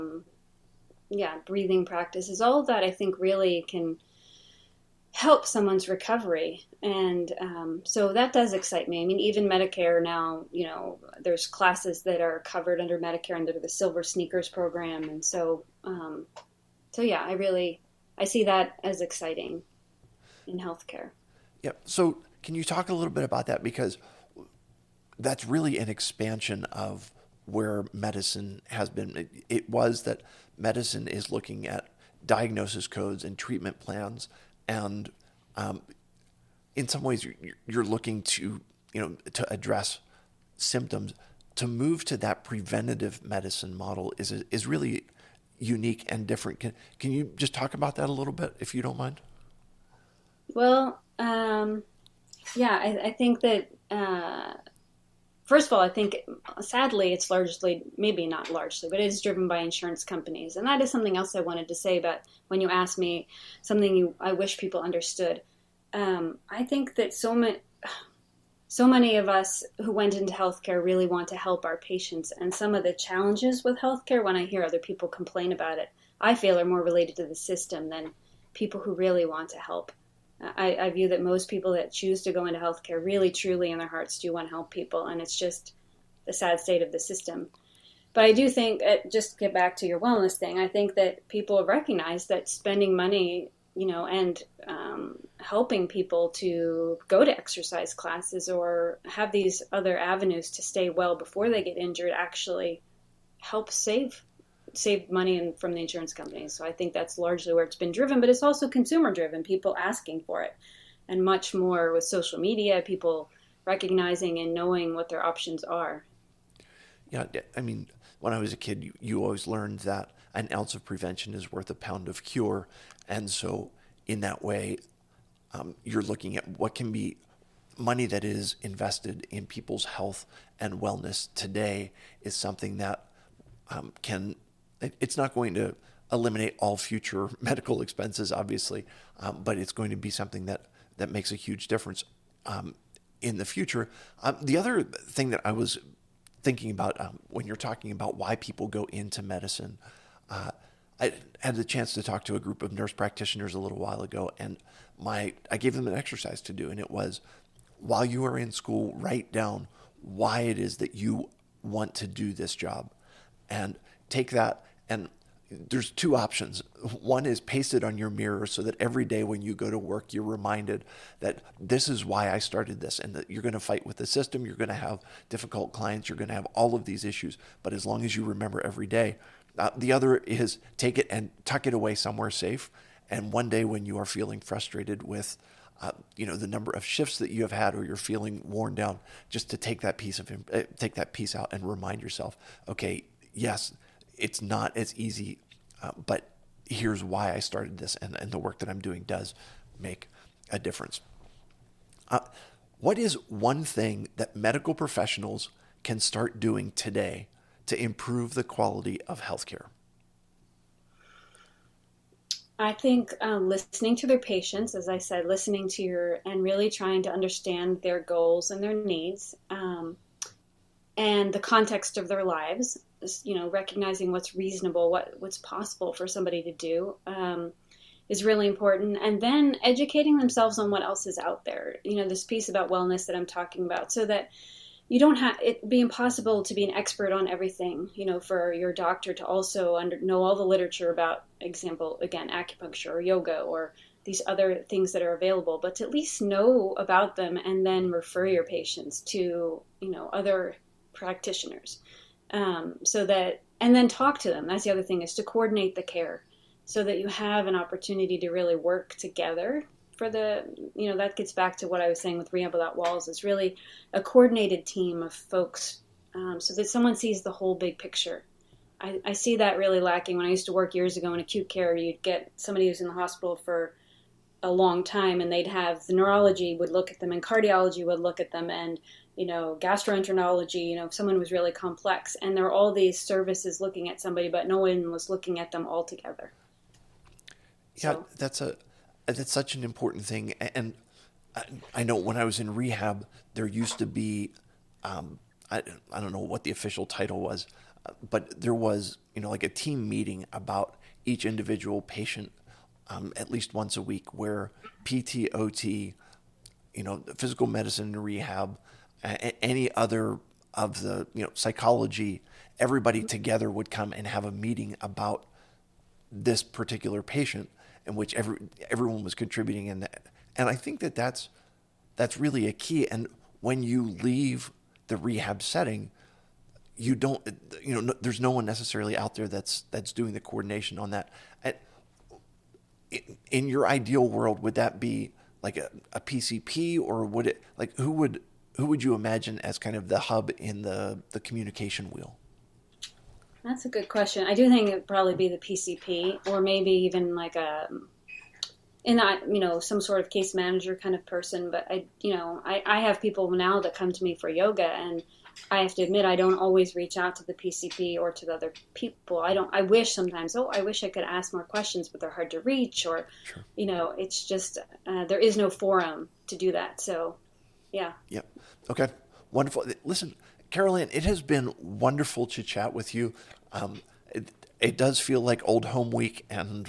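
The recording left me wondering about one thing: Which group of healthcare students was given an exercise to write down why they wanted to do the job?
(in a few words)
nurse practitioners.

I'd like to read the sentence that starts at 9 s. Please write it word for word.
I mean, even Medicare now, you know, there's classes that are covered under Medicare under the Silver Sneakers program.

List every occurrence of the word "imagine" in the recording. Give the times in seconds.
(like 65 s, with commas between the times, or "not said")
338 s.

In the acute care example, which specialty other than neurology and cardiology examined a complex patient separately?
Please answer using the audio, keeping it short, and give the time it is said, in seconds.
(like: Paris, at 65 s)
gastroenterology, at 279 s.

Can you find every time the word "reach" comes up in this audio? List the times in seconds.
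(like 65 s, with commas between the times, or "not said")
356 s, 362 s.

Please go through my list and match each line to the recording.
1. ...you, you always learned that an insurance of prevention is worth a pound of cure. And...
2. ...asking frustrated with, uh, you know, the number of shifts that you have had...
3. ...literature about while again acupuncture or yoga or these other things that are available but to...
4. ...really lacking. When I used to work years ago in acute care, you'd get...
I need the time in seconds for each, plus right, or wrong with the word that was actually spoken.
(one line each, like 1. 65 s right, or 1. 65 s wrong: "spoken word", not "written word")
1. 118 s wrong: "ounce", not "insurance"
2. 184 s wrong: "feeling", not "asking"
3. 240 s wrong: "example", not "while"
4. 269 s right.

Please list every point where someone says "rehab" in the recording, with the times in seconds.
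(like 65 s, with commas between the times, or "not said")
262 s, 292 s, 308 s, 324 s.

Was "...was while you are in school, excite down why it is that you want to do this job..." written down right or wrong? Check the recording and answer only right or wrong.
wrong.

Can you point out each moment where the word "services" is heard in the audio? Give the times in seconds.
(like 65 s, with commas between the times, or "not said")
282 s.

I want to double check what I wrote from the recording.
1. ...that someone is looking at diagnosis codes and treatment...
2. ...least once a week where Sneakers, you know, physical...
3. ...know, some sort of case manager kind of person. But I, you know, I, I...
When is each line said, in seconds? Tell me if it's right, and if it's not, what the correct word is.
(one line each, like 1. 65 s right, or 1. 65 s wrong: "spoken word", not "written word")
1. 30 s wrong: "medicine", not "someone"
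2. 303 s wrong: "PTOT", not "Sneakers"
3. 349 s right.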